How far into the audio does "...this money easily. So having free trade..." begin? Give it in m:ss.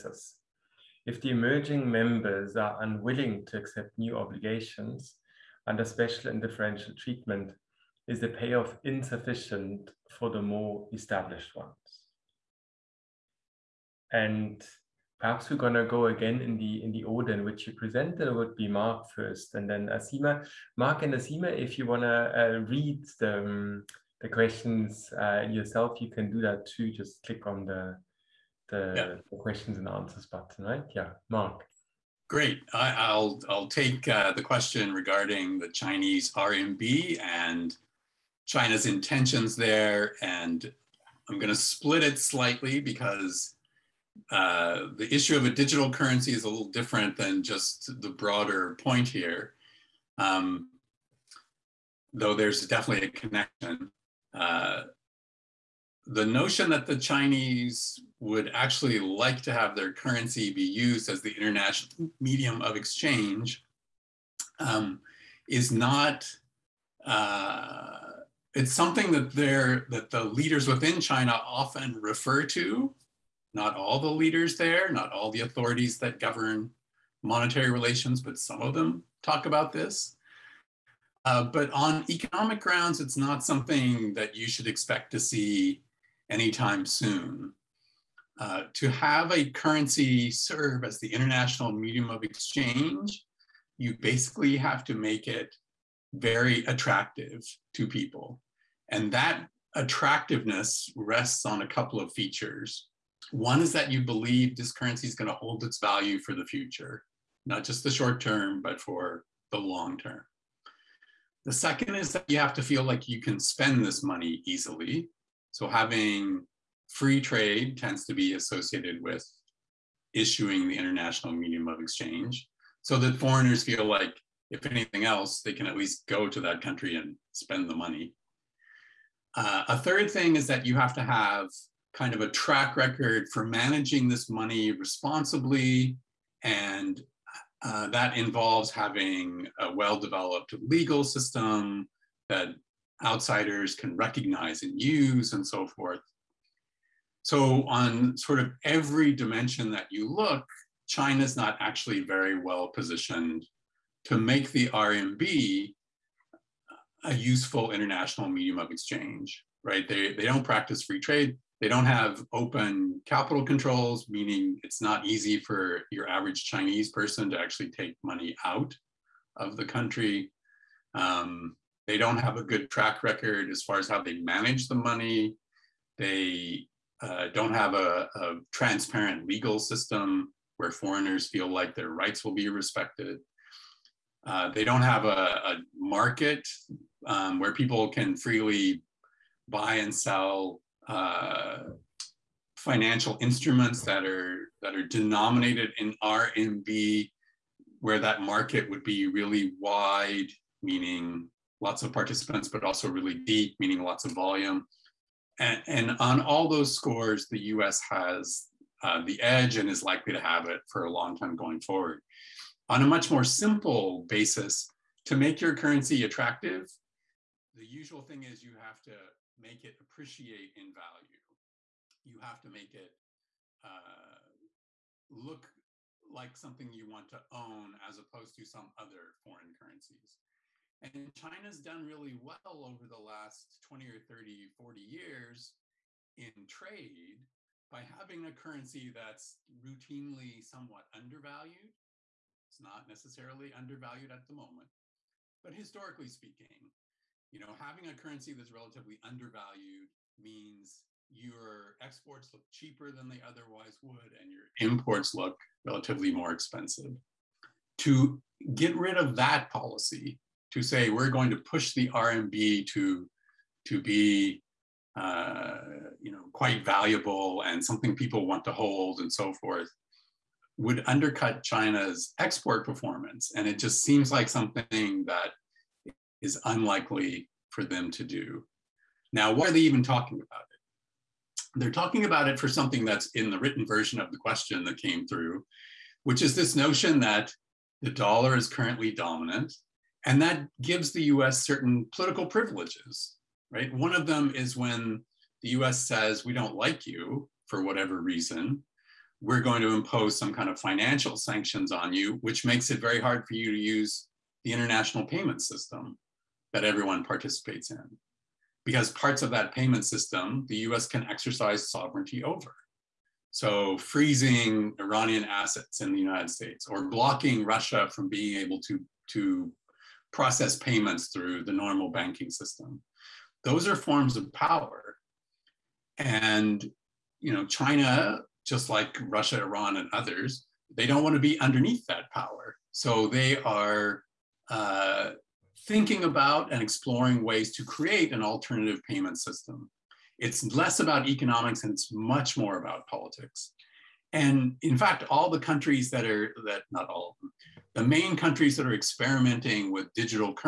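1:53.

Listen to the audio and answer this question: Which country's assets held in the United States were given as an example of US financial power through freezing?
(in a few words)
Iran.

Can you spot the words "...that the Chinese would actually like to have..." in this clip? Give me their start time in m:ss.
0:56.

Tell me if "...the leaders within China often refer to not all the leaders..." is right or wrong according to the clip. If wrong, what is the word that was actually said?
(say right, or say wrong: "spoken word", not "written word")
right.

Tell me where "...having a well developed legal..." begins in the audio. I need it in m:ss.
2:18.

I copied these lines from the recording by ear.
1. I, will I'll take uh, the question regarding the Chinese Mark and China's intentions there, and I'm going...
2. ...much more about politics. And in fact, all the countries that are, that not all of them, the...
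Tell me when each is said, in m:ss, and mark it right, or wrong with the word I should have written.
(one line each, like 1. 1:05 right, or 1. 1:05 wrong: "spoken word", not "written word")
1. 0:32 wrong: "RMB", not "Mark"
2. 5:41 right.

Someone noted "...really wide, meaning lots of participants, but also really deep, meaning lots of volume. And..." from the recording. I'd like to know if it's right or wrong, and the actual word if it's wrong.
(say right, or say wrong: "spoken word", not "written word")
right.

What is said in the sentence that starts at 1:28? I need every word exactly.
Uh, to have a currency serve as the international medium of exchange, you basically have to make it very attractive to people.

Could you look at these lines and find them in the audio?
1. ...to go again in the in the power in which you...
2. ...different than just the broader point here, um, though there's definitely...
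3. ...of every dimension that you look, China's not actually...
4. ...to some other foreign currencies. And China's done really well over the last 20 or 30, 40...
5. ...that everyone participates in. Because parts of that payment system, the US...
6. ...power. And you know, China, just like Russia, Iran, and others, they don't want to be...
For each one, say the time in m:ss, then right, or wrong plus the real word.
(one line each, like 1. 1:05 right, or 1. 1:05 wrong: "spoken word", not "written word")
1. 0:15 wrong: "order", not "power"
2. 0:46 right
3. 2:28 right
4. 3:48 right
5. 5:06 right
6. 5:24 right.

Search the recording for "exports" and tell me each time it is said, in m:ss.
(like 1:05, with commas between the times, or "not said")
4:11, 4:32.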